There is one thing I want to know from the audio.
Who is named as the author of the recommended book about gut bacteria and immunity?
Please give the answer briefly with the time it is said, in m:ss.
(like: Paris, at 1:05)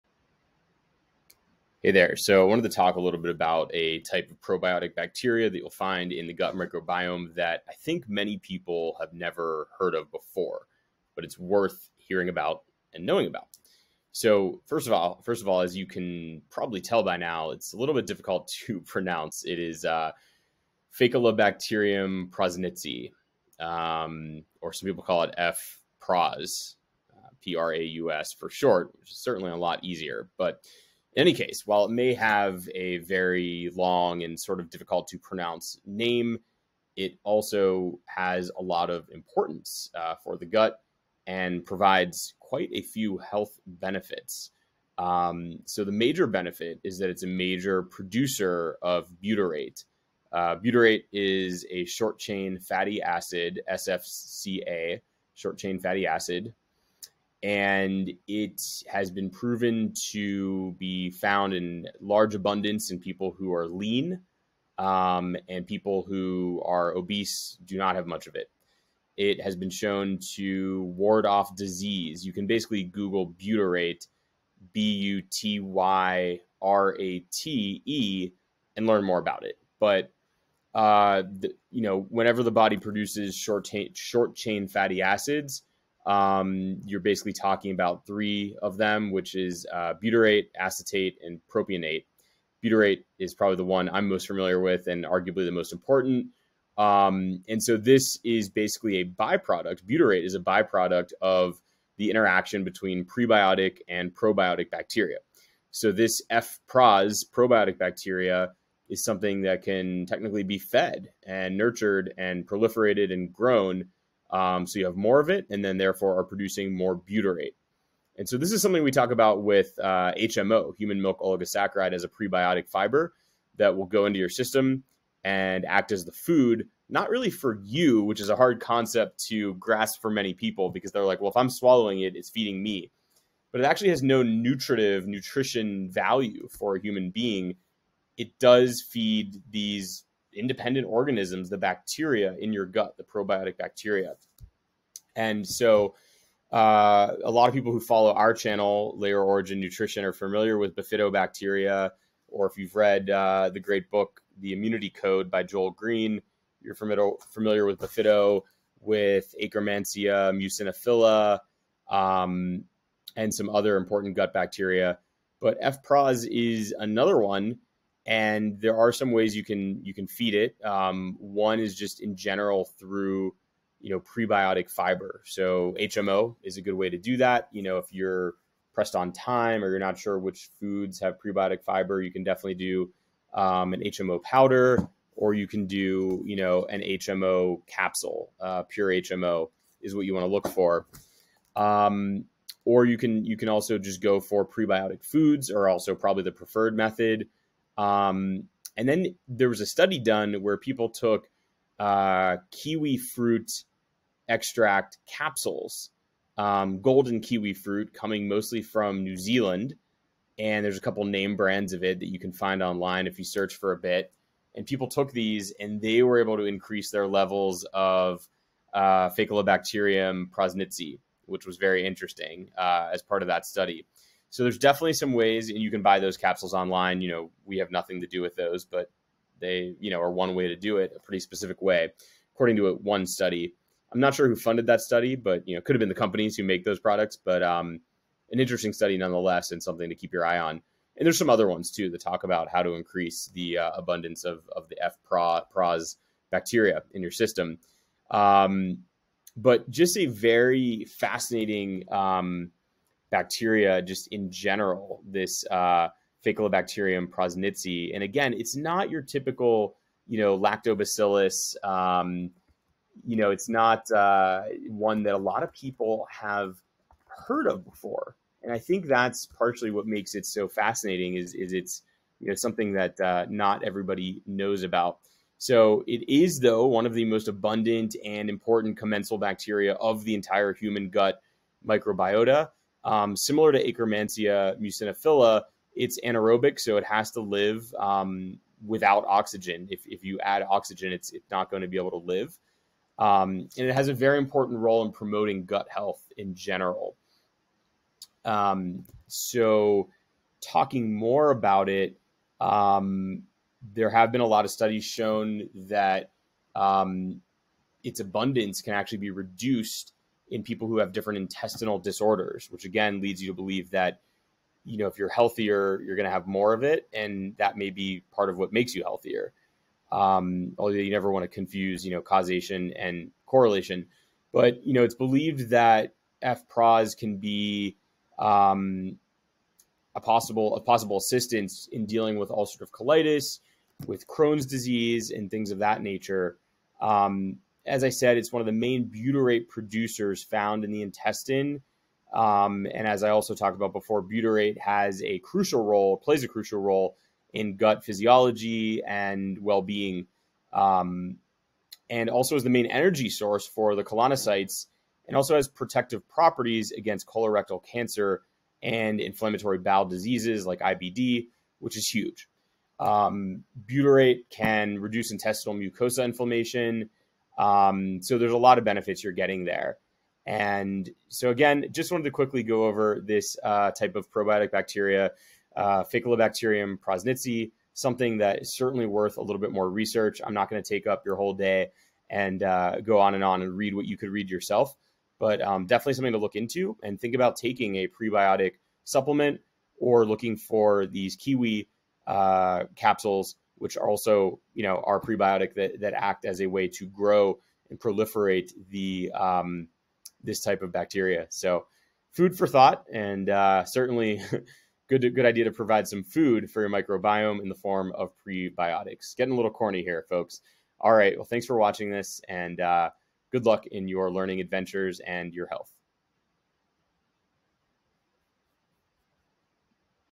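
Joel Greene, at 2:35.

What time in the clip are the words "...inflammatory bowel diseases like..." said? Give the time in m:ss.
5:58.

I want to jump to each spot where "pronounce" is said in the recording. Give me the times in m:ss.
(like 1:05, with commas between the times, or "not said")
0:18, 0:35.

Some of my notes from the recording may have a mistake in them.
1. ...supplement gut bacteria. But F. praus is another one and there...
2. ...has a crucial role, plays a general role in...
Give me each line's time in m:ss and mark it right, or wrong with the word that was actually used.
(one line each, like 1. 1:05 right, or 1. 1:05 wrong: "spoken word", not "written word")
1. 2:43 wrong: "important", not "supplement"
2. 5:44 wrong: "crucial", not "general".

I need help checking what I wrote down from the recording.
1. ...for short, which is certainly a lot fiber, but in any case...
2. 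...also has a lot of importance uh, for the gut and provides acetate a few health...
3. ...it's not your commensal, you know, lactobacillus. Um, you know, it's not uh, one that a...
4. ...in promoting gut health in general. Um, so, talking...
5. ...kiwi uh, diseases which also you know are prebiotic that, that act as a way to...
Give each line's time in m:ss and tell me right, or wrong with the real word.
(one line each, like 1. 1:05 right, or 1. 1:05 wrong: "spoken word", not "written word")
1. 0:28 wrong: "easier", not "fiber"
2. 0:37 wrong: "quite", not "acetate"
3. 4:18 wrong: "typical", not "commensal"
4. 4:54 right
5. 6:31 wrong: "capsules", not "diseases".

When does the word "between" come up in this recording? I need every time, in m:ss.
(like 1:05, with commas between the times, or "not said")
1:42.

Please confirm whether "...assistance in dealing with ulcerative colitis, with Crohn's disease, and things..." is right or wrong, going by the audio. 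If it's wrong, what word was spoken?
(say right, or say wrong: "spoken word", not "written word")
right.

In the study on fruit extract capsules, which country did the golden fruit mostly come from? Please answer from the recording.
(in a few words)
New Zealand.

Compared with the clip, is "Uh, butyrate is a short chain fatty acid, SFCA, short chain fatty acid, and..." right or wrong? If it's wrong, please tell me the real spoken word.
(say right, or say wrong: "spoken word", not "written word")
right.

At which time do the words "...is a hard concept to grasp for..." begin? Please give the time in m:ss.
2:08.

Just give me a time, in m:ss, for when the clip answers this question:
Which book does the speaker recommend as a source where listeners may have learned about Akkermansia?
2:34.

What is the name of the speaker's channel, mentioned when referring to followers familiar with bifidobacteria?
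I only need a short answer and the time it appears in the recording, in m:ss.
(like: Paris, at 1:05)
Layer Origin Nutrition, at 2:28.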